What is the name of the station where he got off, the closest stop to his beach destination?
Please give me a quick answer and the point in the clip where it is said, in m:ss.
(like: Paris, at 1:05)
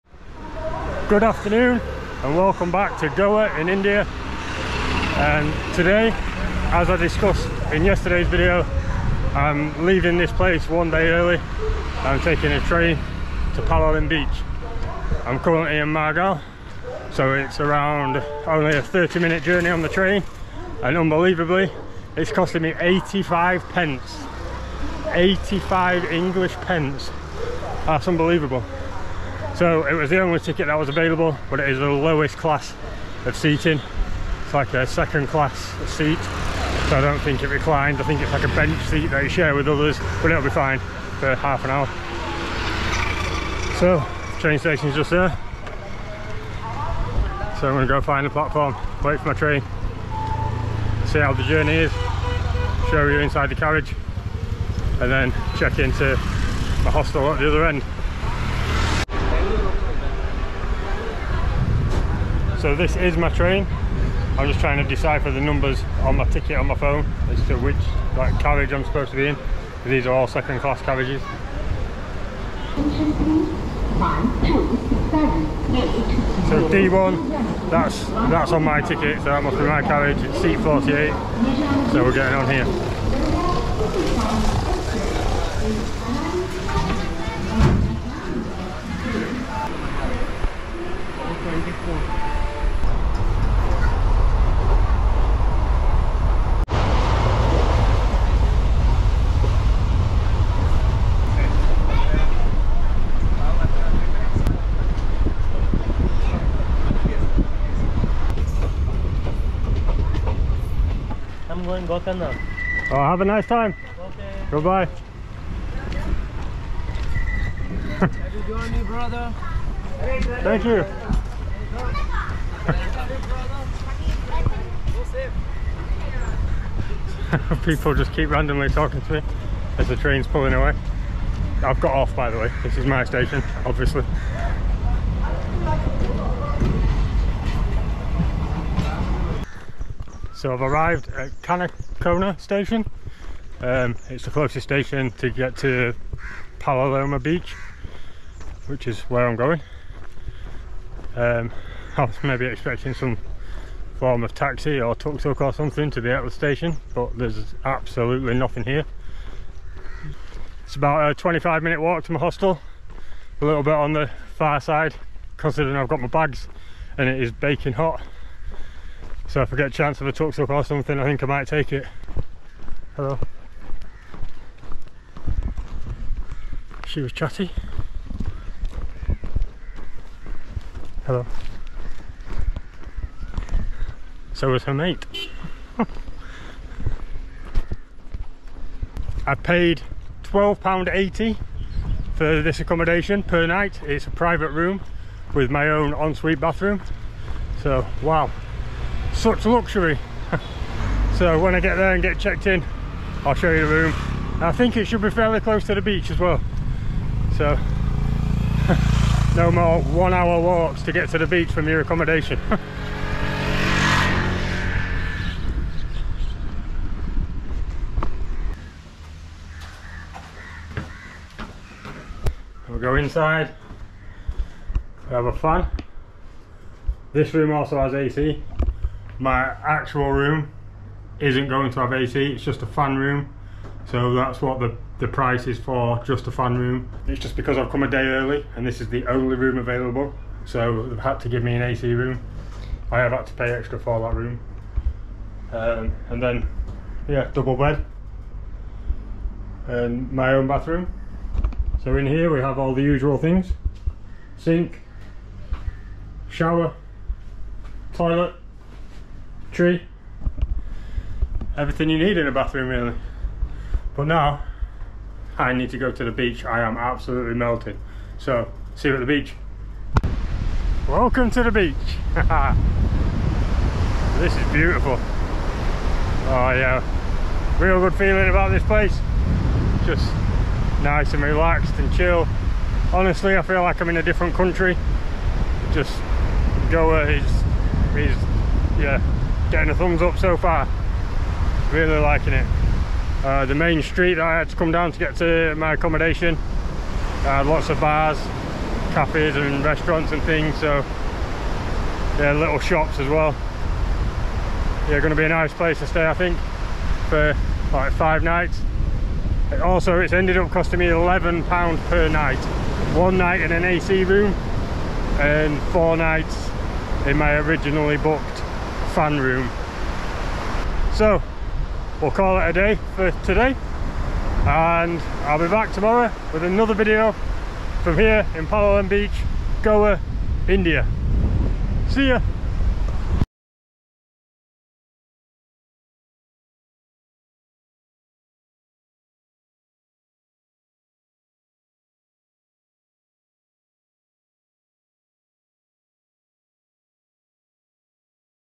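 Canacona, at 2:21.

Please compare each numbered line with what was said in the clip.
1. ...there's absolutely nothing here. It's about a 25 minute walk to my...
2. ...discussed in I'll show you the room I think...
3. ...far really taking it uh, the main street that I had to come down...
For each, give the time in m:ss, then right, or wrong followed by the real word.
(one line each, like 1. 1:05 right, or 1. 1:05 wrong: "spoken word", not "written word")
1. 2:37 right
2. 3:22 wrong: "checked", not "discussed"
3. 4:50 wrong: "liking", not "taking".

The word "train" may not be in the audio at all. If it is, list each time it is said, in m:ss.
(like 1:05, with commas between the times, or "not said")
0:12, 0:19, 0:44, 0:49, 1:03, 2:09.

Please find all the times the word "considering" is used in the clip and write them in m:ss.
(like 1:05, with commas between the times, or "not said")
2:45.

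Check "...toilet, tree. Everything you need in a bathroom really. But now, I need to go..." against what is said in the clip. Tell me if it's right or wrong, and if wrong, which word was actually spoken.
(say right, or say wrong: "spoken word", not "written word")
right.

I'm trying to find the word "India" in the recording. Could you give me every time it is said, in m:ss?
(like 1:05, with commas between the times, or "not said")
0:03, 5:30.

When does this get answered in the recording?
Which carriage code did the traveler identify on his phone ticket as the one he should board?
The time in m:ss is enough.
1:16.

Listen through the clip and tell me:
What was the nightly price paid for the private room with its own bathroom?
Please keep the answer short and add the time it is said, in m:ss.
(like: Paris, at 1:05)
£12.80, at 3:10.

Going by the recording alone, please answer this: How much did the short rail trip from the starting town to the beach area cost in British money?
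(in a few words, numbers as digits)
85 pence.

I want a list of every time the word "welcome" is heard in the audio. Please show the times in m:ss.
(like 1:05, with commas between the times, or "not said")
0:02, 4:30.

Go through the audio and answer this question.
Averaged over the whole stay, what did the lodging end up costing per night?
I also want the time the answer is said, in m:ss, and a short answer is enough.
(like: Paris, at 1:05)
11 pounds, at 5:10.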